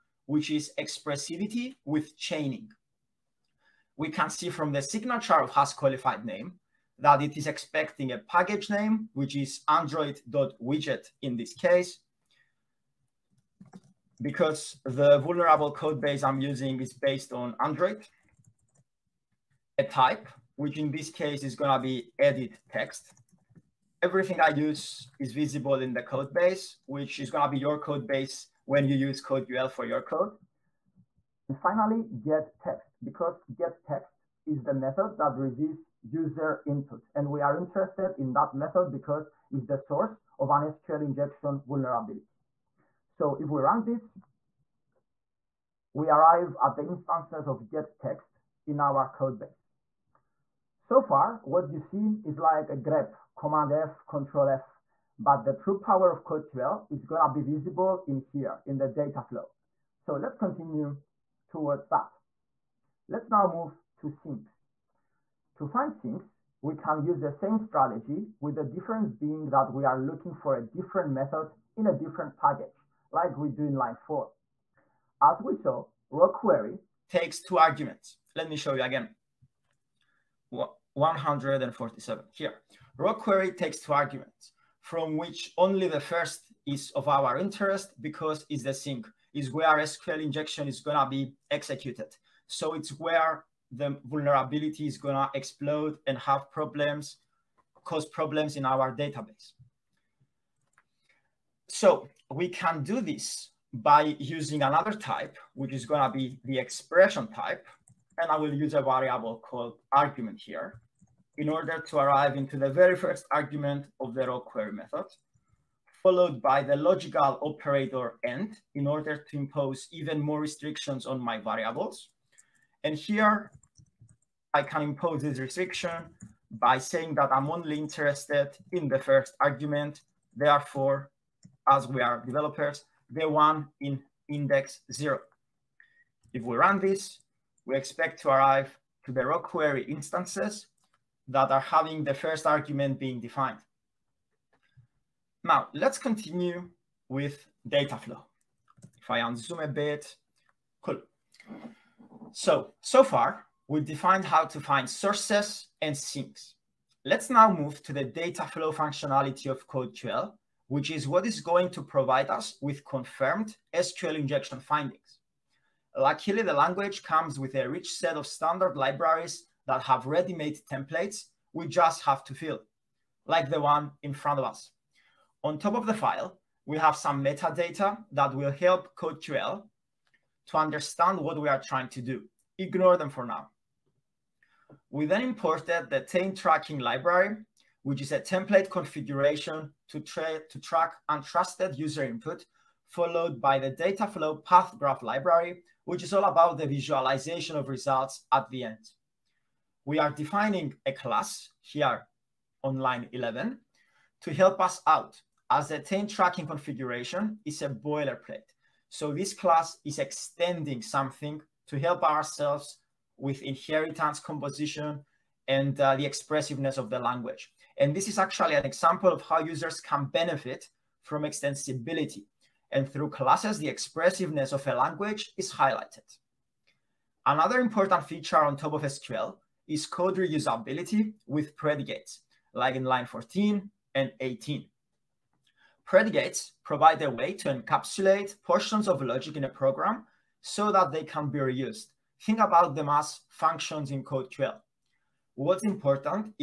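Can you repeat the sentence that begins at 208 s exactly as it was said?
So this class is extending something to help ourselves with inheritance composition and uh, the expressiveness of the language.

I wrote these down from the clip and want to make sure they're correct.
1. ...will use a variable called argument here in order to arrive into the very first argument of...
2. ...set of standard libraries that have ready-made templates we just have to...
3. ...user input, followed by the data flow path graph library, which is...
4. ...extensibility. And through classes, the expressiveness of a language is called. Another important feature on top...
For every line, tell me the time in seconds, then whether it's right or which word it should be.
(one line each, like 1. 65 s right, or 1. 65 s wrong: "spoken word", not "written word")
1. 108 s right
2. 167 s right
3. 191 s right
4. 221 s wrong: "highlighted", not "called".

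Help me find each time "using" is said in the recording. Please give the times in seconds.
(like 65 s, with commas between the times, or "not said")
16 s, 104 s.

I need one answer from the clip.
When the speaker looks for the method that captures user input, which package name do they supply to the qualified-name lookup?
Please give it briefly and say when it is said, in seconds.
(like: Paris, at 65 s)
android.widget, at 9 s.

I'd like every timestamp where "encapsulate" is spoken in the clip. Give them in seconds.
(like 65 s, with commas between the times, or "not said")
237 s.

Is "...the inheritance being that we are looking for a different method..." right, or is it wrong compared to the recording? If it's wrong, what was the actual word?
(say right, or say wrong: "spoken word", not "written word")
wrong: "difference", not "inheritance".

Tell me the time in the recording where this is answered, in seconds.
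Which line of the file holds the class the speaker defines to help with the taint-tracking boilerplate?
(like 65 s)
202 s.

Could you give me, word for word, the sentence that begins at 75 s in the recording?
As we saw, raw query takes two arguments.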